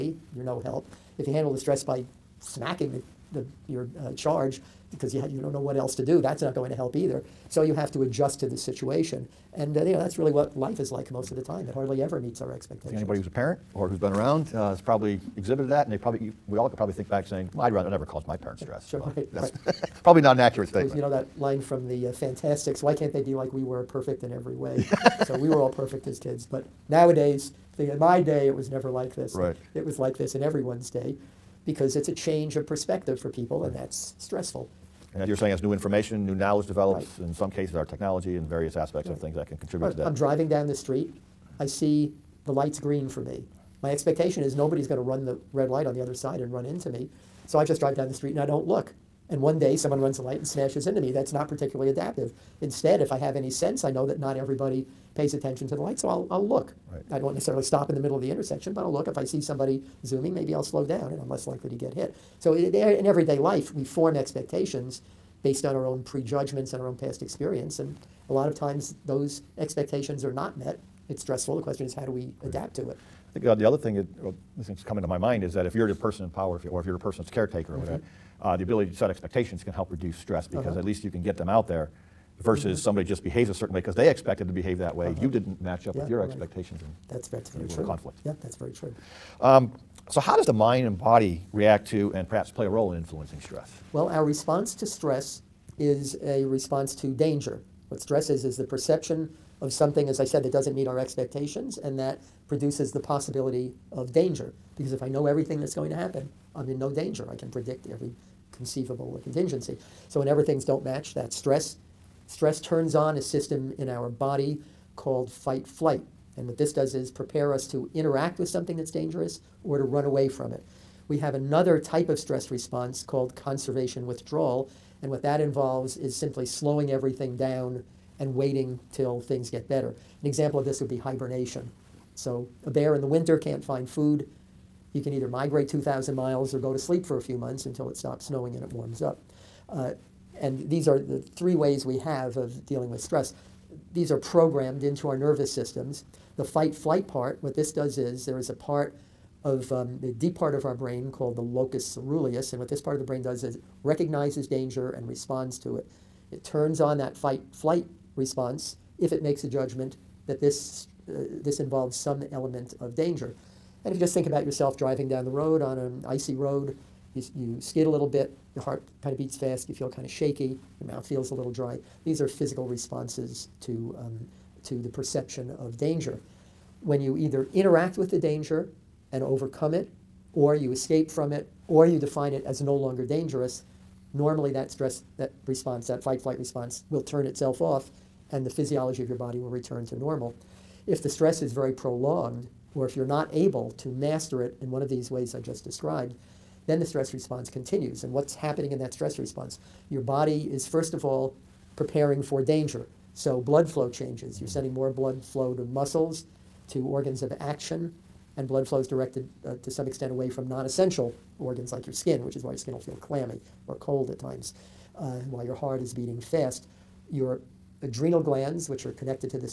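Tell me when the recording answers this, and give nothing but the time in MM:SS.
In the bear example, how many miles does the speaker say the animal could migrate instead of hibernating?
02:15.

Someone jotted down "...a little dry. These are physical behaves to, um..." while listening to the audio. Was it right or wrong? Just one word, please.
wrong.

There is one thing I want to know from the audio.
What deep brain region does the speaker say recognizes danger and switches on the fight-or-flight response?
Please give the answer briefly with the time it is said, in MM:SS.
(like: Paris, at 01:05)
Locus ceruleus, at 02:31.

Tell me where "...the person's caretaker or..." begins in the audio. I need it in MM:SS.
01:16.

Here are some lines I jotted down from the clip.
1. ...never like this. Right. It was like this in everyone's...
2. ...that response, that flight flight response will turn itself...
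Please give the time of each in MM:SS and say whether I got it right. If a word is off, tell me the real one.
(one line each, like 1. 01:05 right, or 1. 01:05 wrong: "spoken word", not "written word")
1. 00:28 right
2. 03:05 wrong: "fight", not "flight".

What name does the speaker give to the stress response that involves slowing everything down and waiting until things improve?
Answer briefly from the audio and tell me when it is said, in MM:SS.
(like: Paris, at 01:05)
Conservation withdrawal, at 02:03.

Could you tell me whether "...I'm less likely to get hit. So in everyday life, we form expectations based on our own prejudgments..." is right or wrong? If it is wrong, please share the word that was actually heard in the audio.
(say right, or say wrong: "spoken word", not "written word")
right.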